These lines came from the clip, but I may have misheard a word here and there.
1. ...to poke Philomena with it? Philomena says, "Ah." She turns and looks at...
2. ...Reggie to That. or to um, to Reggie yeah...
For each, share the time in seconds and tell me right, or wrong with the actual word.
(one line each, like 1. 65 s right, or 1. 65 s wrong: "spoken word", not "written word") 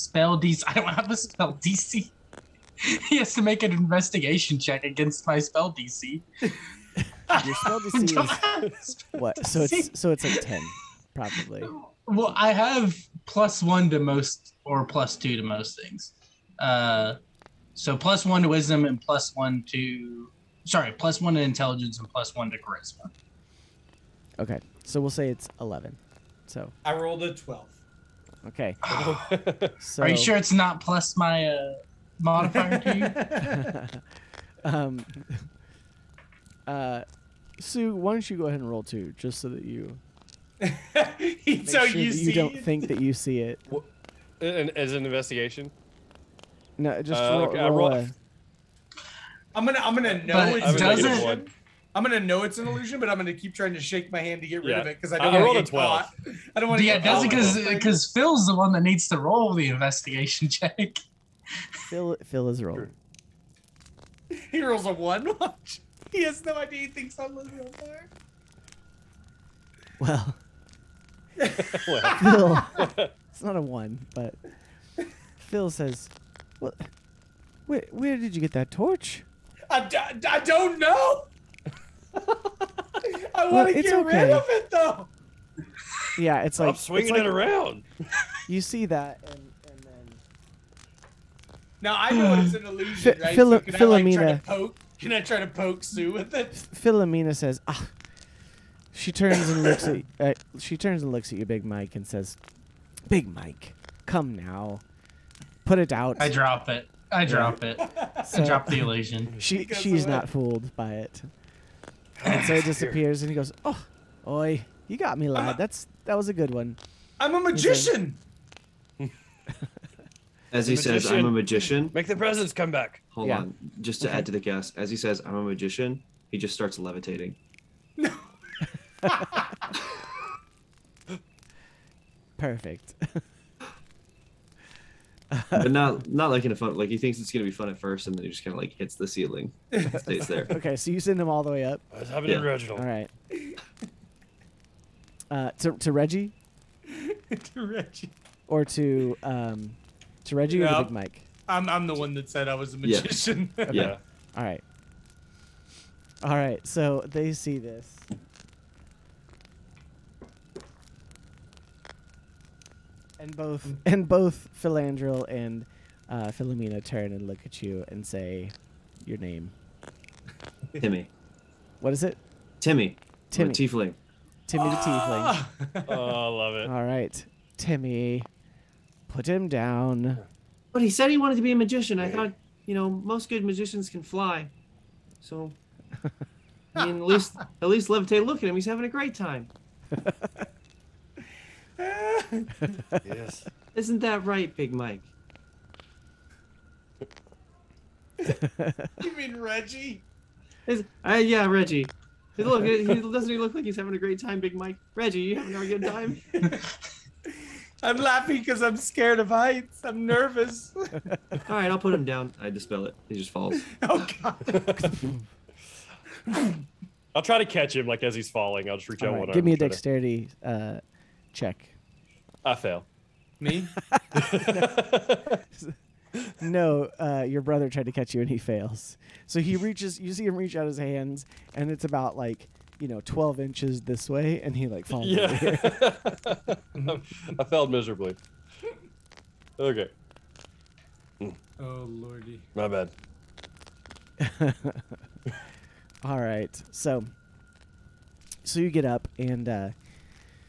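1. 95 s wrong: "Sue", not "Philomena"
2. 145 s wrong: "Reggie", not "That".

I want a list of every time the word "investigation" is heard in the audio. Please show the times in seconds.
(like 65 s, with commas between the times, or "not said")
3 s, 45 s, 59 s.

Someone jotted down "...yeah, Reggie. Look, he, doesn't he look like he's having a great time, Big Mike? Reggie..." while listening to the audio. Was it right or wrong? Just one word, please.
right.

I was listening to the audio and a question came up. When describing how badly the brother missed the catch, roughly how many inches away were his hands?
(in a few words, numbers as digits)
12.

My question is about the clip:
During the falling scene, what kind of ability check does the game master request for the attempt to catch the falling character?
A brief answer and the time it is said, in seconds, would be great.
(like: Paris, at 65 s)
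Dexterity, at 219 s.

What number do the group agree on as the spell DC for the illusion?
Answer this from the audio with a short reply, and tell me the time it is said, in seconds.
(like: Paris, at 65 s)
11, at 25 s.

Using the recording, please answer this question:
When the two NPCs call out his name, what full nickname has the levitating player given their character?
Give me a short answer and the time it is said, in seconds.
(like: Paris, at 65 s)
Timmy the Tiefling, at 174 s.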